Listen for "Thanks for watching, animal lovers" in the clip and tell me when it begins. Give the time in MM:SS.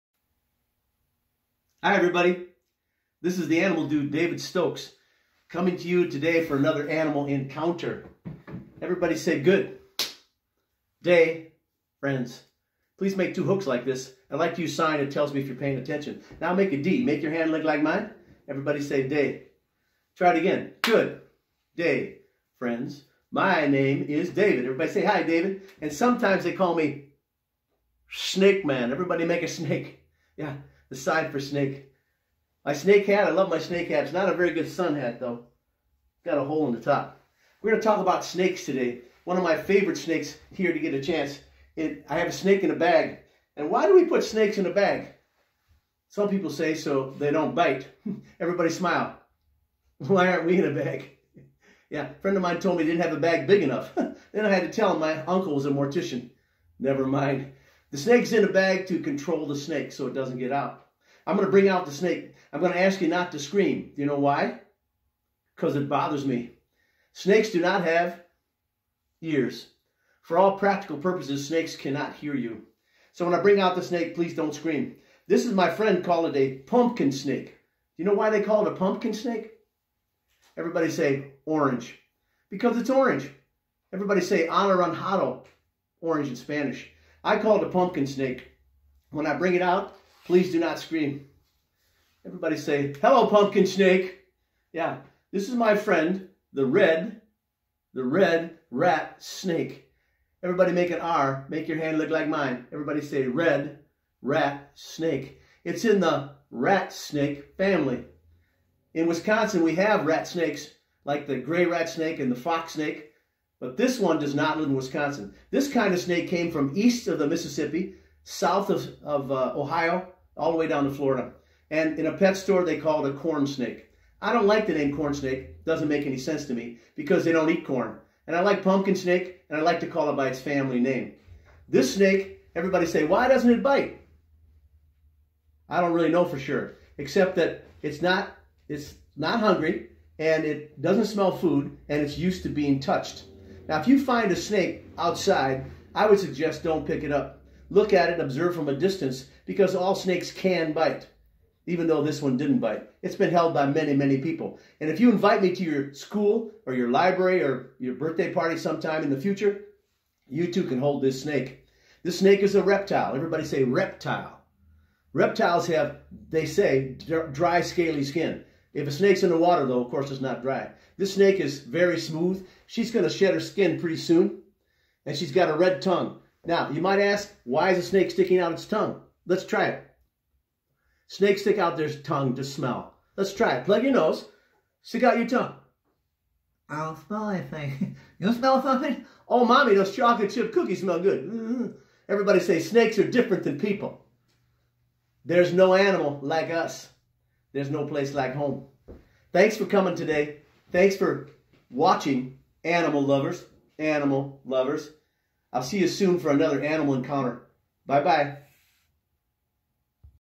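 03:20.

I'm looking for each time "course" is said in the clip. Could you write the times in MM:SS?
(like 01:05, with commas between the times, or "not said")
02:49.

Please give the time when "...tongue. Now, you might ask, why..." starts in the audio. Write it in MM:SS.
02:55.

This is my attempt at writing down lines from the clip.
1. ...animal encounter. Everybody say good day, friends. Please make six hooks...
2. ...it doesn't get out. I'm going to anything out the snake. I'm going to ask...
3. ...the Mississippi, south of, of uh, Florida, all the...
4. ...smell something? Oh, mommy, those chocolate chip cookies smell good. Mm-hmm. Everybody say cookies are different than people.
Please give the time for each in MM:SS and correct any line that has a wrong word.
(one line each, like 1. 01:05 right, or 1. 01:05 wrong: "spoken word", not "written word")
1. 00:06 wrong: "two", not "six"
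2. 01:00 wrong: "bring", not "anything"
3. 01:57 wrong: "Ohio", not "Florida"
4. 03:08 wrong: "snakes", not "cookies".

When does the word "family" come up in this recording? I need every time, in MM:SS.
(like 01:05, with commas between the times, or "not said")
01:47, 02:10.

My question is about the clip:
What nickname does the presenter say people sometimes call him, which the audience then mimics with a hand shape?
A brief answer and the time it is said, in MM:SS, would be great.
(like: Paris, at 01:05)
Snake Man, at 00:28.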